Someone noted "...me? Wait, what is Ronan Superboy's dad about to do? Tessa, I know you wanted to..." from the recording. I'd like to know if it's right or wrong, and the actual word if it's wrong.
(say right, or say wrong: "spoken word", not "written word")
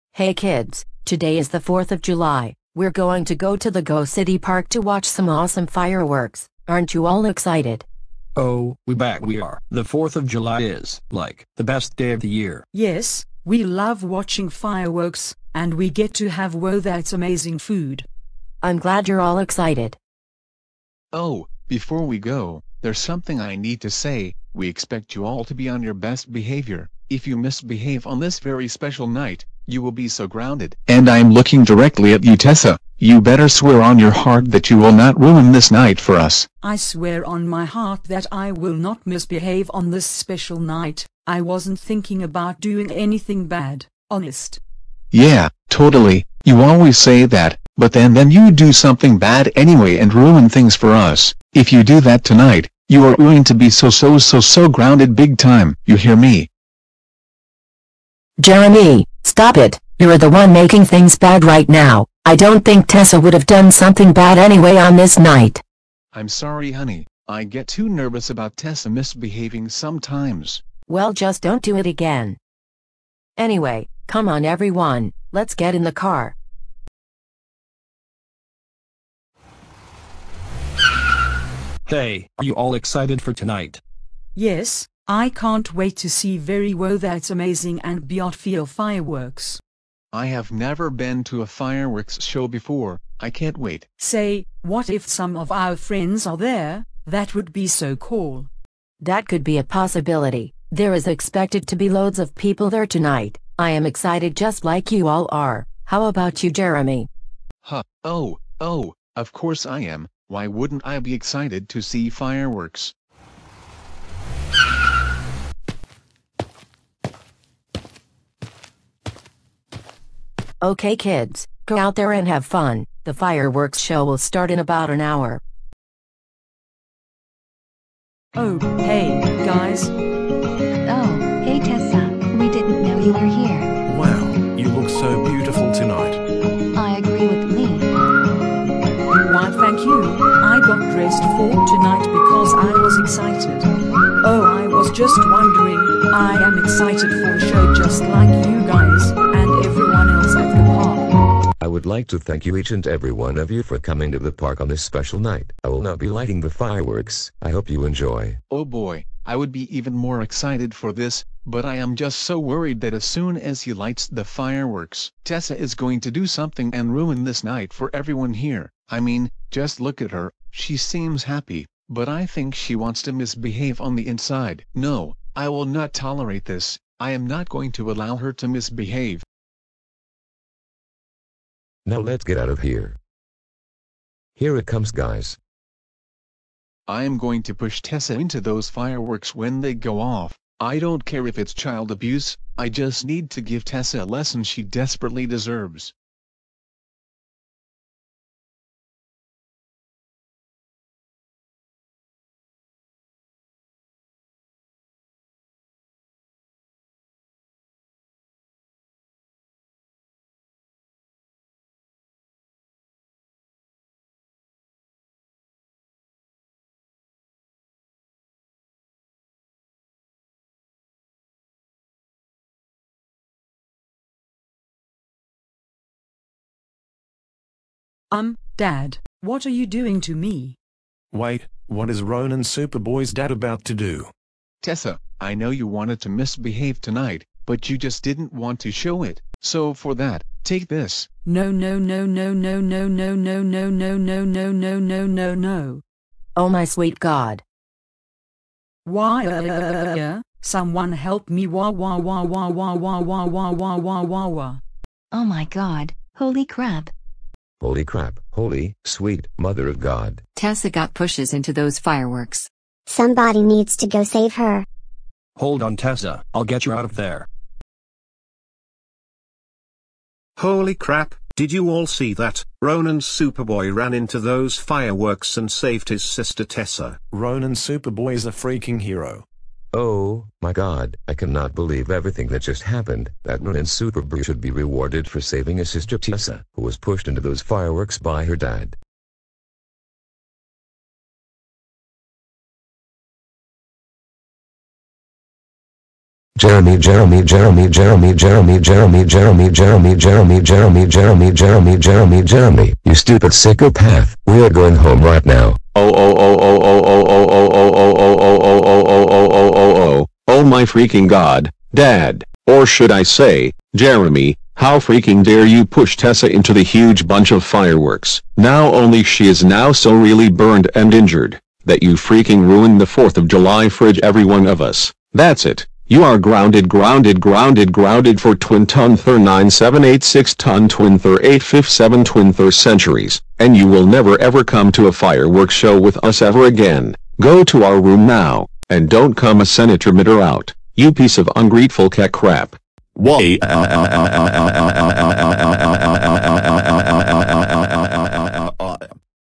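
right.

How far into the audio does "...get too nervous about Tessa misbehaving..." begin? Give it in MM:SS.
01:07.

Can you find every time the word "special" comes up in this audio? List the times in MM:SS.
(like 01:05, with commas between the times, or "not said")
00:28, 00:40, 02:34.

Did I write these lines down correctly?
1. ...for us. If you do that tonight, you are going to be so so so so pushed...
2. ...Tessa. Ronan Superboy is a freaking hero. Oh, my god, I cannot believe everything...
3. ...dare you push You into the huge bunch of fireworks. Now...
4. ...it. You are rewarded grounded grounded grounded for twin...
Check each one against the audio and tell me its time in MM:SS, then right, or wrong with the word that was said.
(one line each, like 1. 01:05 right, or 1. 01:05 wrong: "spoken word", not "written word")
1. 00:50 wrong: "grounded", not "pushed"
2. 04:36 right
3. 05:15 wrong: "Tessa", not "You"
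4. 05:25 wrong: "grounded", not "rewarded".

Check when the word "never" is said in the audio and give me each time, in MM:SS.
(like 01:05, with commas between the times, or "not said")
01:30, 05:33.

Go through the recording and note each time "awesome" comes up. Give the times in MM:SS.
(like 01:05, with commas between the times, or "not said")
00:05.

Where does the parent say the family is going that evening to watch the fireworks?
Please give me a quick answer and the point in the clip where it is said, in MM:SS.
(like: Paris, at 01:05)
Go City Park, at 00:03.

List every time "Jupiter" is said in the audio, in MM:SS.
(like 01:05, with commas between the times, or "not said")
not said.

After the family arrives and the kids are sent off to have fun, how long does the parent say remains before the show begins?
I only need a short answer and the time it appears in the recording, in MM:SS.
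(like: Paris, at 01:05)
about 1 hour, at 02:04.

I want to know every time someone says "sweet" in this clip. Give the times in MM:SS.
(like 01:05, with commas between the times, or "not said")
04:06, 04:18.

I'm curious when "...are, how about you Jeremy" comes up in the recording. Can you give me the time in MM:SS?
01:45.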